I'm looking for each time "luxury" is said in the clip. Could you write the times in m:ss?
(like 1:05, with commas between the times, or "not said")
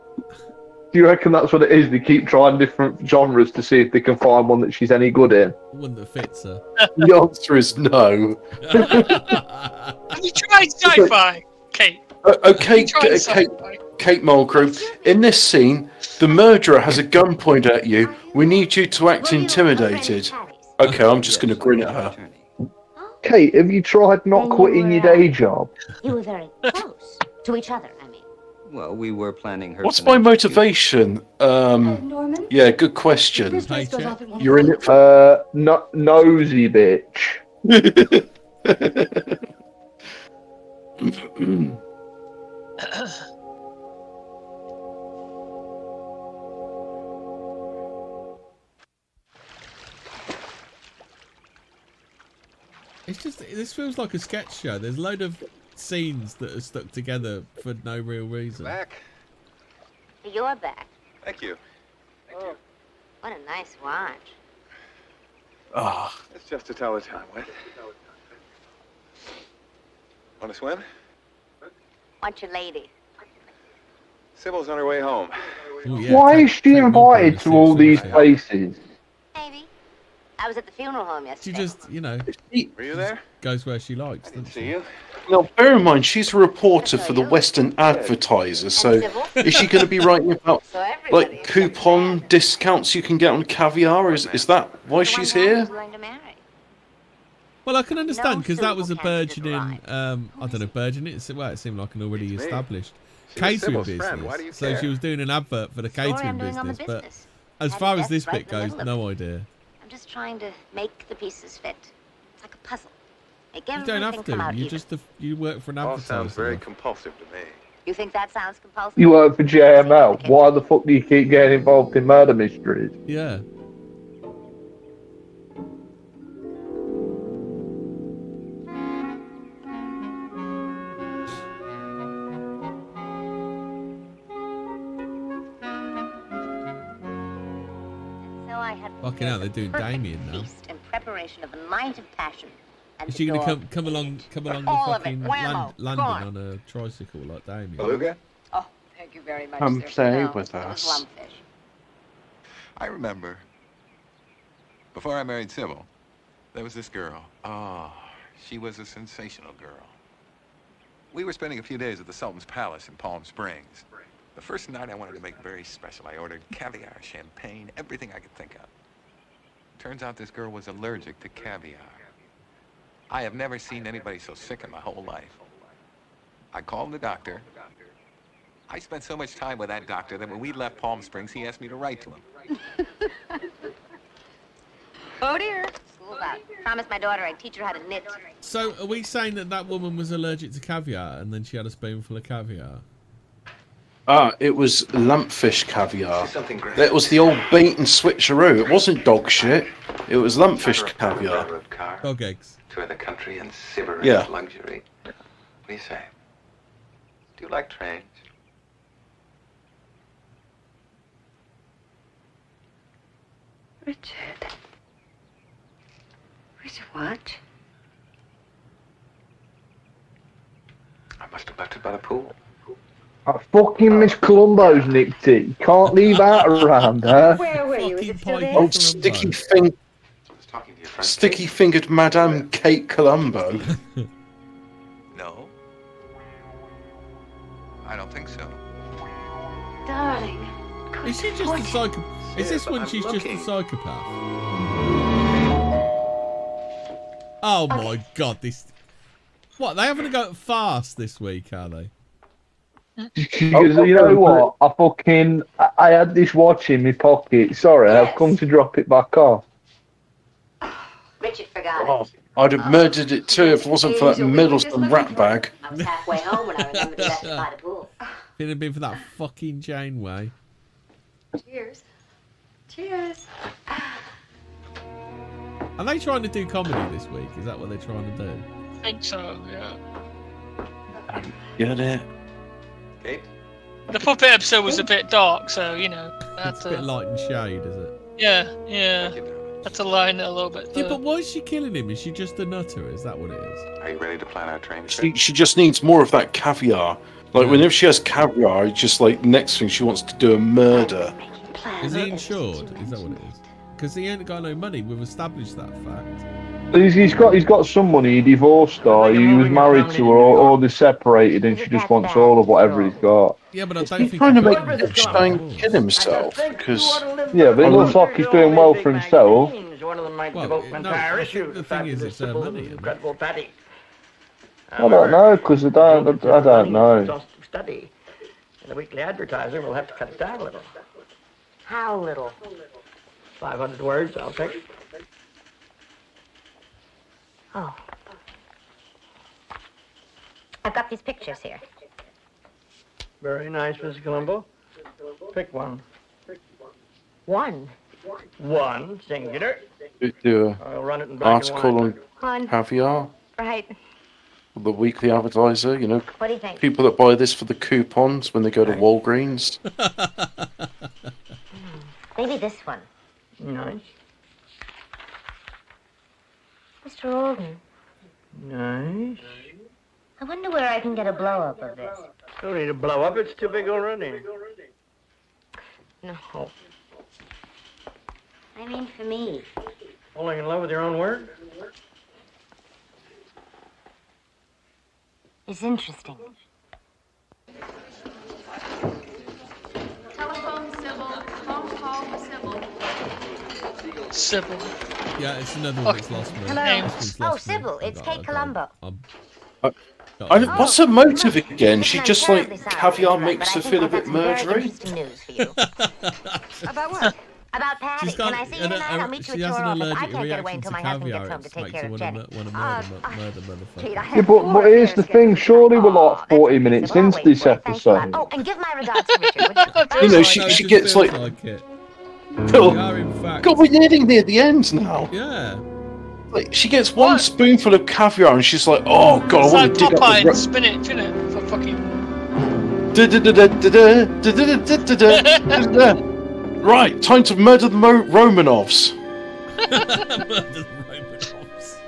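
3:24.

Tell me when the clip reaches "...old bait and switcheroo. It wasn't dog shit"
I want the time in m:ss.
3:17.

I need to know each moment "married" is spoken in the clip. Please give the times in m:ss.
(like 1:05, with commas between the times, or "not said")
2:35, 5:09.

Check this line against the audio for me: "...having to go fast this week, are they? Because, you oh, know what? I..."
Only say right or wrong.
right.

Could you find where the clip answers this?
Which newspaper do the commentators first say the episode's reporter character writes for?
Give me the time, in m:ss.
1:27.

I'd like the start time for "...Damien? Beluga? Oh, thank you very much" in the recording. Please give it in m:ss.
2:27.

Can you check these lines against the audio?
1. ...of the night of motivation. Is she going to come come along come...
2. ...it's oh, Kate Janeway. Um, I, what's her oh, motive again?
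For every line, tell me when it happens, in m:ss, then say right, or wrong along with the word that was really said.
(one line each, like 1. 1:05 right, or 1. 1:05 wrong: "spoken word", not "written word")
1. 2:21 wrong: "passion", not "motivation"
2. 6:37 wrong: "Columbo", not "Janeway".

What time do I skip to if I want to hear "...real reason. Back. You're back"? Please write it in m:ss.
0:57.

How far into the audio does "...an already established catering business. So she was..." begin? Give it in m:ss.
1:41.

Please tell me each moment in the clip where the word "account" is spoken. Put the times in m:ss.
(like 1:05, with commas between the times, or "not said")
not said.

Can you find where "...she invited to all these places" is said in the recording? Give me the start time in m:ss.
1:16.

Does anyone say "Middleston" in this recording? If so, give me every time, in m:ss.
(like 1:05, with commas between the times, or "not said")
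4:24.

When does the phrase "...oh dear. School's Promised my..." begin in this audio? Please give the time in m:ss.
3:05.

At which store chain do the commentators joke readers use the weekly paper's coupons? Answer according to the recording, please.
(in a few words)
Walgreens.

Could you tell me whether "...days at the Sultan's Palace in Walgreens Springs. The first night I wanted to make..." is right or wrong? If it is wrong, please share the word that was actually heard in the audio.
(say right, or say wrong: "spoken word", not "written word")
wrong: "Palm", not "Walgreens".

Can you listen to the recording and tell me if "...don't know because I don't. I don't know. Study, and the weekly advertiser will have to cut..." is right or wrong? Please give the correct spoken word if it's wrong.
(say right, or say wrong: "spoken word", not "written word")
right.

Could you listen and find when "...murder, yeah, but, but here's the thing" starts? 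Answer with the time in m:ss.
6:53.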